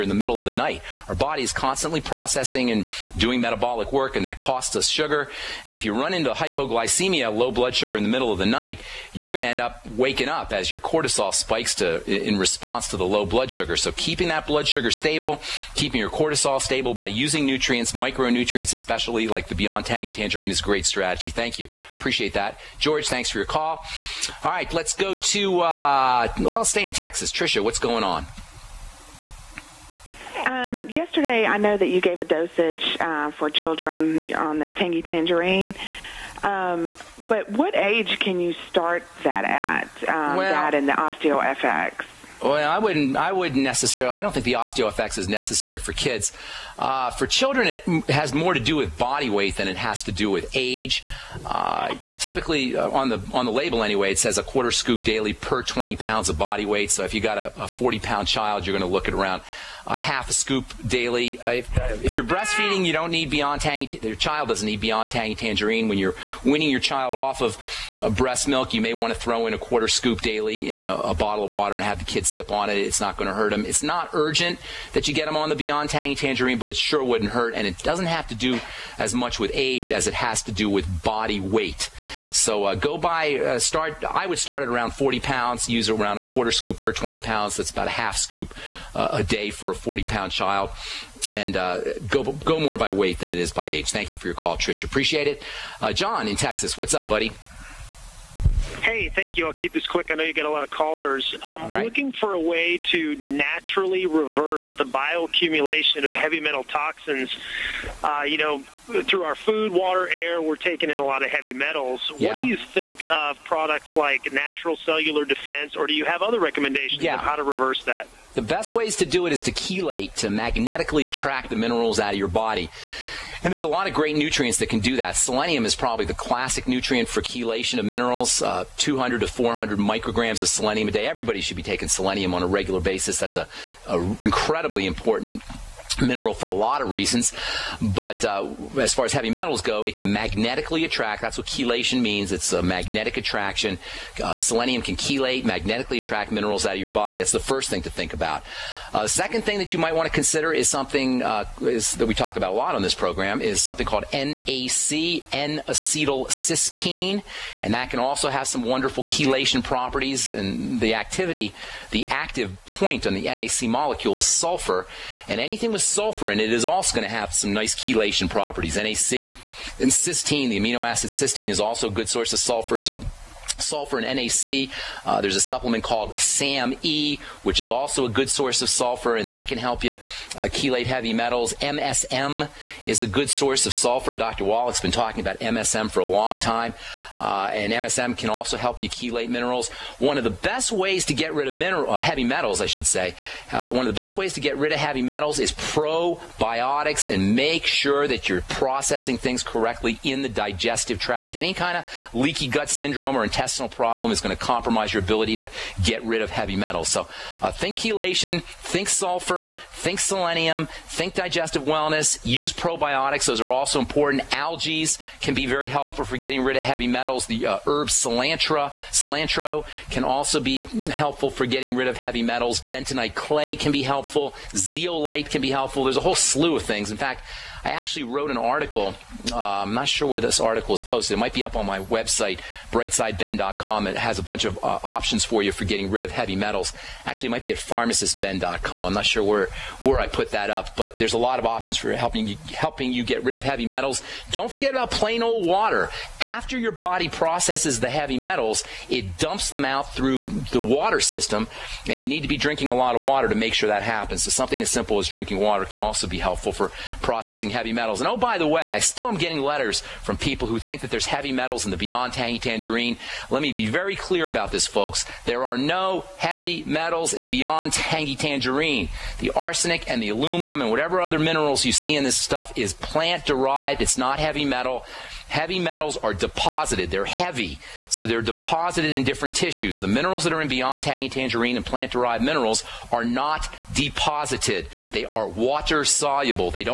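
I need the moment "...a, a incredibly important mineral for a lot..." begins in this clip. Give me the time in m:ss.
2:13.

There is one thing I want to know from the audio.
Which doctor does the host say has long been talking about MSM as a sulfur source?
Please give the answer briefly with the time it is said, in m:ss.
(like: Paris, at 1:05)
Dr. Wallach, at 3:04.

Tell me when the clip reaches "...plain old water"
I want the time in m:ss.
4:04.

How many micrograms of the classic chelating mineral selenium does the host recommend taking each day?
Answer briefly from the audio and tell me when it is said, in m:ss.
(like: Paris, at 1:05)
200 to 400 micrograms, at 2:08.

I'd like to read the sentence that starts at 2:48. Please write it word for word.
NAC and cysteine, the amino acid cysteine, is also a good source of sulfur.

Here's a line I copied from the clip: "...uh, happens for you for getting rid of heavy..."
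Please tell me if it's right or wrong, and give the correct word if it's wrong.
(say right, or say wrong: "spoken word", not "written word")
wrong: "options", not "happens".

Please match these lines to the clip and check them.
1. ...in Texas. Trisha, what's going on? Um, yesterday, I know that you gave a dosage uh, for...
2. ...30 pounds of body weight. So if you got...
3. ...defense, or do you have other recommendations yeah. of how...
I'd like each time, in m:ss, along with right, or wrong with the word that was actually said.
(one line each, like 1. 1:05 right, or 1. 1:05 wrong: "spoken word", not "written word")
1. 0:26 right
2. 0:55 wrong: "20", not "30"
3. 1:55 right.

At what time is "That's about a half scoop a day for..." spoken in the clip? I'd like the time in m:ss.
1:27.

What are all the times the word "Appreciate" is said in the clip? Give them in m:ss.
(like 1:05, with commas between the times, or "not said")
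0:21, 1:34.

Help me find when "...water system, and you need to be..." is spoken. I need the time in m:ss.
4:10.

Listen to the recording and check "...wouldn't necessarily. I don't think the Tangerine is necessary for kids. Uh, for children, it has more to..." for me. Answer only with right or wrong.
wrong.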